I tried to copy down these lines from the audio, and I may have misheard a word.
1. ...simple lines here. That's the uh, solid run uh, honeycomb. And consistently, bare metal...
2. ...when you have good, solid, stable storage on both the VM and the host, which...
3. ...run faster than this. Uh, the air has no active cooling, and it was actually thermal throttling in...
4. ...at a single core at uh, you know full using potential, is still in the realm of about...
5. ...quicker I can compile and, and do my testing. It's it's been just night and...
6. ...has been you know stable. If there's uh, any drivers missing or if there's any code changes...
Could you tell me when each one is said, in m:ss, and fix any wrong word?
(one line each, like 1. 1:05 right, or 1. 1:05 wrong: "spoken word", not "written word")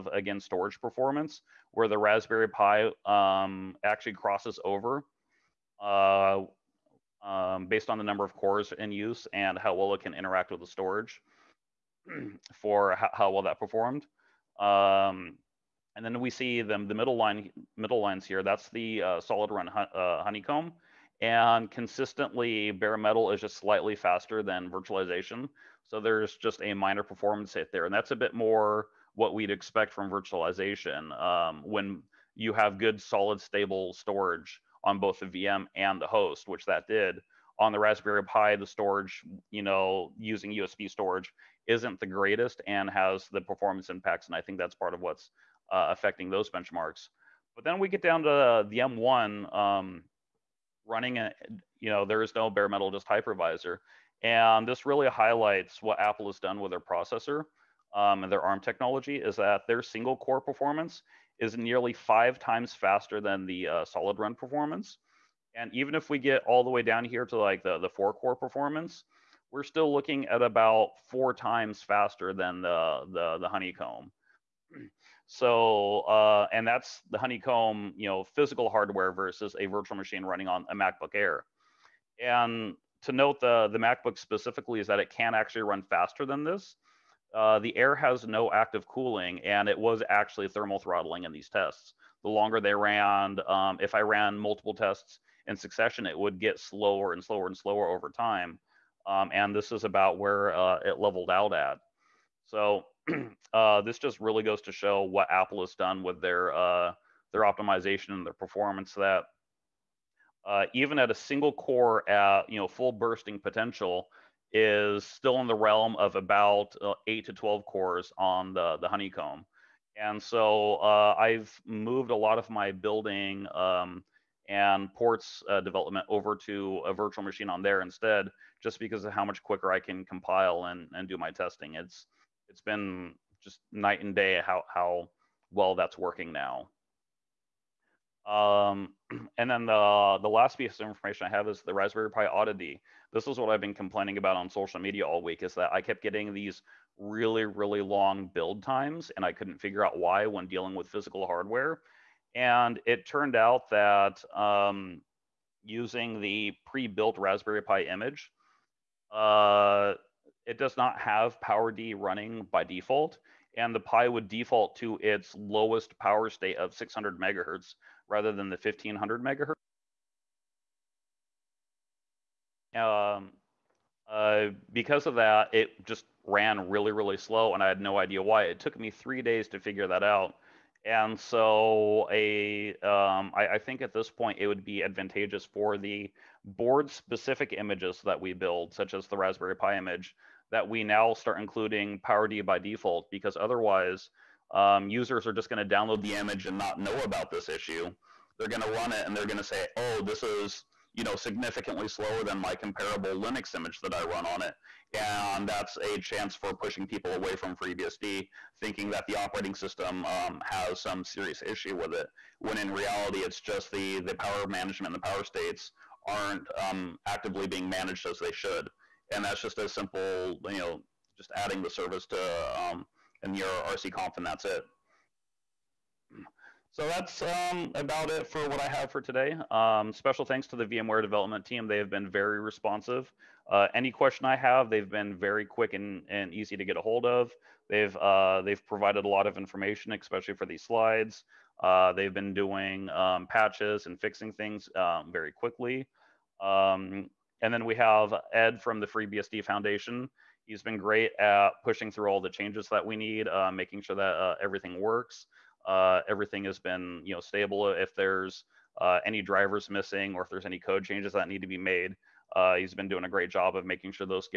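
1. 0:17 wrong: "middle", not "simple"
2. 0:31 right
3. 1:25 right
4. 1:50 wrong: "bursting", not "using"
5. 2:09 right
6. 4:16 right.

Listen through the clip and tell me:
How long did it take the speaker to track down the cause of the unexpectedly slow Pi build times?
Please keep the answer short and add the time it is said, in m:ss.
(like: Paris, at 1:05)
3 days, at 2:58.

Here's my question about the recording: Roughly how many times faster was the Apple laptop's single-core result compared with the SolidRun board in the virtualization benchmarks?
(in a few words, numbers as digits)
5 times.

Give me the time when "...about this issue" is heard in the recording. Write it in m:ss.
3:17.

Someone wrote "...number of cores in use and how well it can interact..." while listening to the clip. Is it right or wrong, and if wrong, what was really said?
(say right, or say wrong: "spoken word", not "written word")
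right.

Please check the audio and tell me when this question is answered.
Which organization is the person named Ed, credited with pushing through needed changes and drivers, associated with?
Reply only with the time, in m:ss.
4:08.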